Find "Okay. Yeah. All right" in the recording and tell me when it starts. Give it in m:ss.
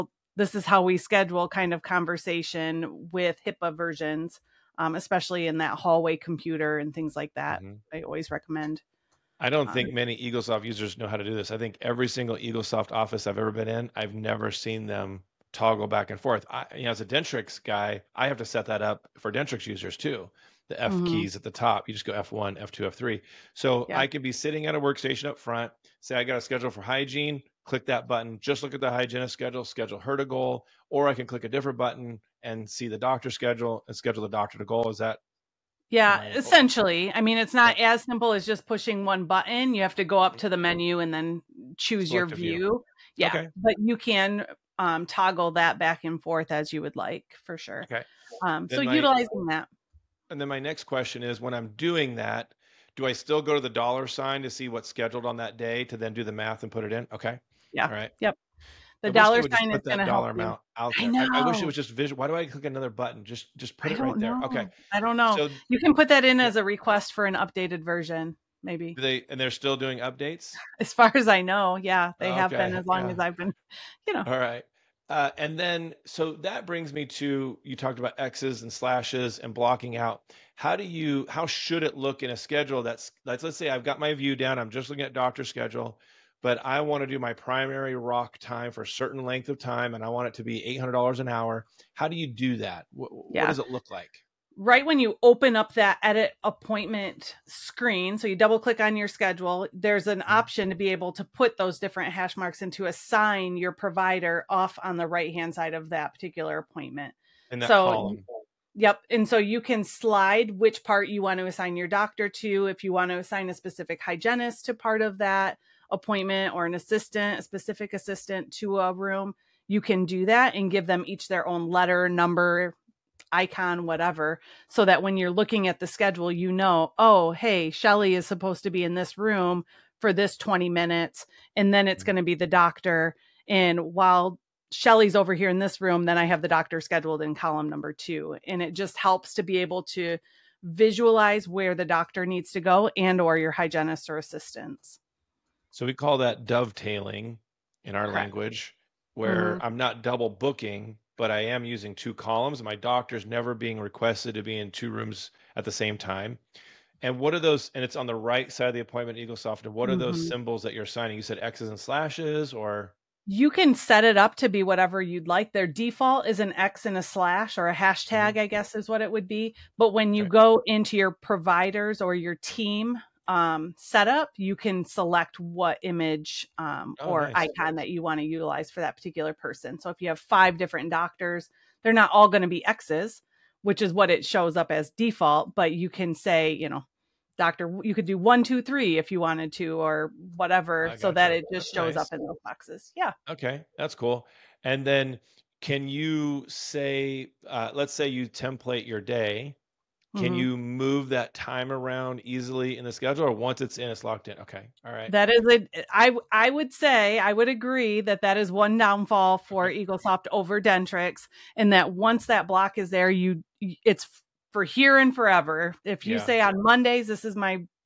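0:57.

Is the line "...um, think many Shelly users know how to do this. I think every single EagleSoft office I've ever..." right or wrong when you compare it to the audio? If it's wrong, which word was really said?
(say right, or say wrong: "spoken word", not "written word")
wrong: "EagleSoft", not "Shelly".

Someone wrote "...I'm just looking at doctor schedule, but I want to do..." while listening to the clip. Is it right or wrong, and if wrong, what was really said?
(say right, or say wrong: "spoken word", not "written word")
right.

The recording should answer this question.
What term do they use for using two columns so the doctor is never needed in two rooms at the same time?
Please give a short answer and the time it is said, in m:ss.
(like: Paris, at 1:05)
dovetailing, at 2:26.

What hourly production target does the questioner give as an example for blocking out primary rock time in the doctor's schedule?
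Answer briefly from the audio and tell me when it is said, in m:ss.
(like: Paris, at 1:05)
$800, at 1:30.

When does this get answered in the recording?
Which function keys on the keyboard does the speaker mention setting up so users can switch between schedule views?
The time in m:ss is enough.
0:22.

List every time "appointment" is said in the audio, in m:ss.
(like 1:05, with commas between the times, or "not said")
1:36, 1:46, 1:55, 2:38.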